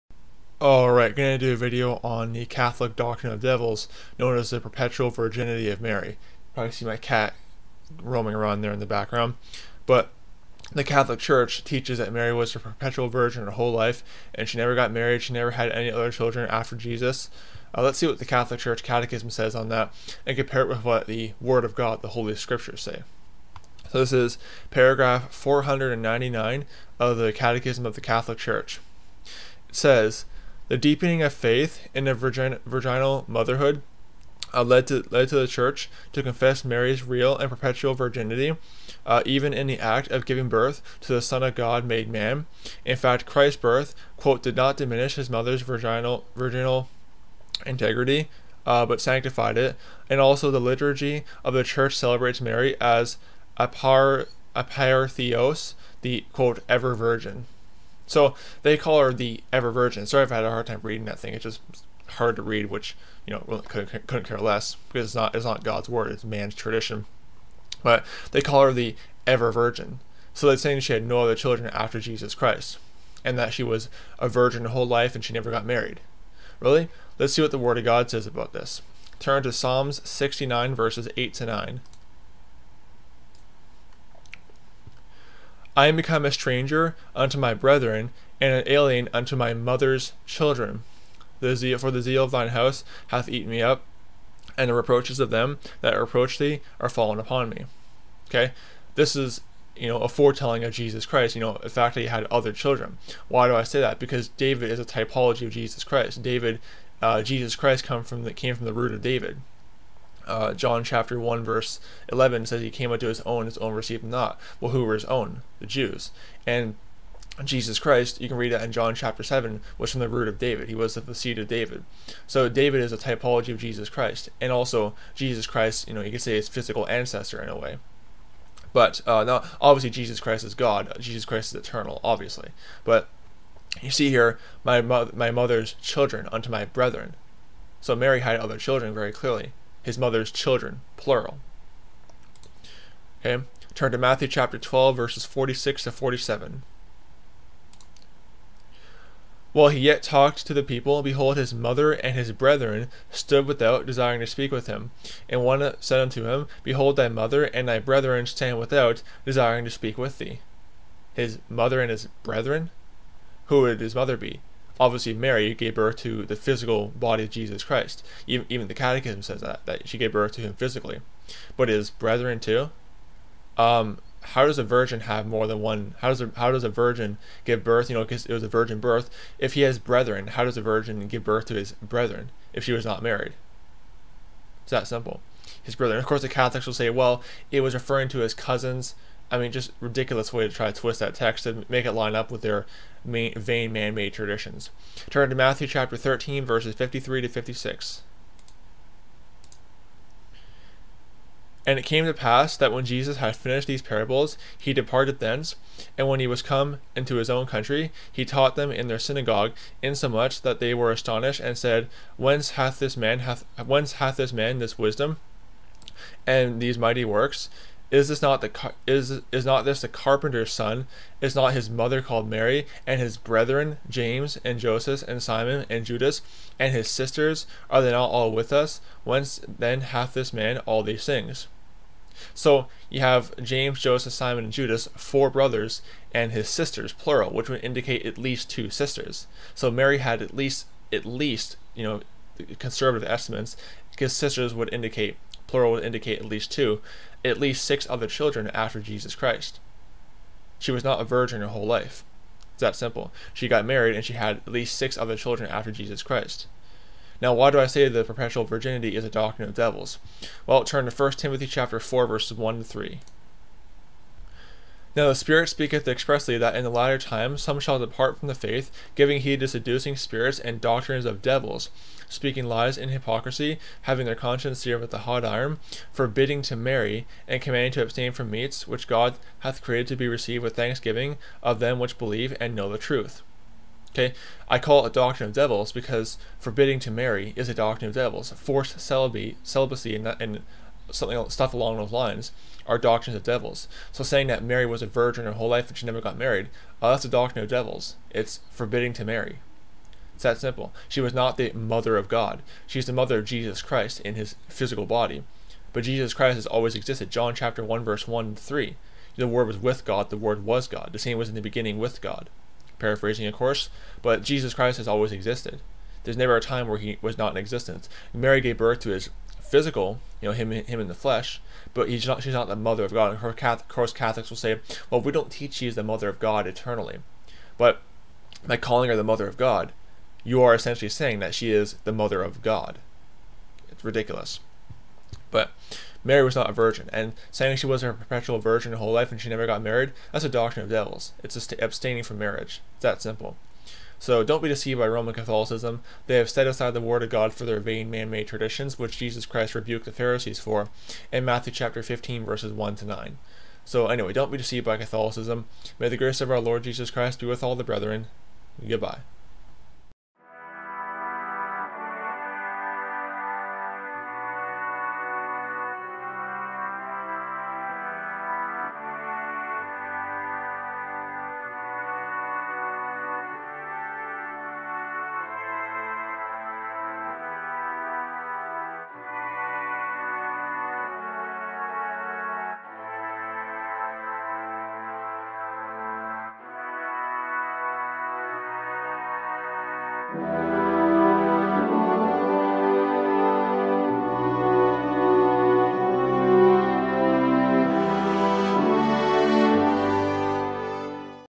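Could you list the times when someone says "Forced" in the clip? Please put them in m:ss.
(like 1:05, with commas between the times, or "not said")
4:48.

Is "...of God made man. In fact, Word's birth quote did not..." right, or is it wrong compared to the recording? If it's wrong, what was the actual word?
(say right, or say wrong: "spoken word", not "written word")
wrong: "Christ", not "Word".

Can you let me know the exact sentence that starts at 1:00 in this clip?
Sorry I've had a hard time reading that thing.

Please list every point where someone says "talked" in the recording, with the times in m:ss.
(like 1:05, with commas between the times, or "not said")
2:30.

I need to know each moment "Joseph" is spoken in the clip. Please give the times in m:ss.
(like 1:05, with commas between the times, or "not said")
3:44, 3:53.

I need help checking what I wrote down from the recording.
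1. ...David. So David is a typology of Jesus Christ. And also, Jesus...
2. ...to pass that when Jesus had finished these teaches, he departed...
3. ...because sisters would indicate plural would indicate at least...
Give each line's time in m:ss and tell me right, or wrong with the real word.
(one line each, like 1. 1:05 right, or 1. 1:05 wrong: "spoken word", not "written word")
1. 2:01 right
2. 3:22 wrong: "parables", not "teaches"
3. 4:03 right.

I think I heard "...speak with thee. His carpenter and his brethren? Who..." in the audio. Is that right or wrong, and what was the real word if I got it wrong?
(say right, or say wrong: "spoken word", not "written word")
wrong: "mother", not "carpenter".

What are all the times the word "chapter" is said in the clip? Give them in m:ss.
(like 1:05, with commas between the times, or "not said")
1:50, 1:58, 2:24, 3:15, 4:21, 5:07, 5:51.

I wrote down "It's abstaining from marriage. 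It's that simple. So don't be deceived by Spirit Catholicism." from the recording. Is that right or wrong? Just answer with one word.
wrong.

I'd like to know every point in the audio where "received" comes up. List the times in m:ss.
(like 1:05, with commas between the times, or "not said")
1:53, 4:40.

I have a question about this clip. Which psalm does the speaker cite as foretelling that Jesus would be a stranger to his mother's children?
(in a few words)
Psalms 69.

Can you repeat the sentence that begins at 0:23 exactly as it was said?
So this is paragraph 499 of the Catechism of the Catholic Church.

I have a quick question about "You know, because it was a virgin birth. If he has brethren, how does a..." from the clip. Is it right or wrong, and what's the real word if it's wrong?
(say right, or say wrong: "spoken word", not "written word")
right.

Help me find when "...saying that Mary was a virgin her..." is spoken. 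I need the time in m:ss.
4:54.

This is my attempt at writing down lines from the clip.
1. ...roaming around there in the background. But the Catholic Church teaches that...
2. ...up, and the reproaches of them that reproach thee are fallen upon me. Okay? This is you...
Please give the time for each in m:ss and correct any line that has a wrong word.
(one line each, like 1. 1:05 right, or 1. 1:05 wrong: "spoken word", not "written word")
1. 0:07 right
2. 1:33 right.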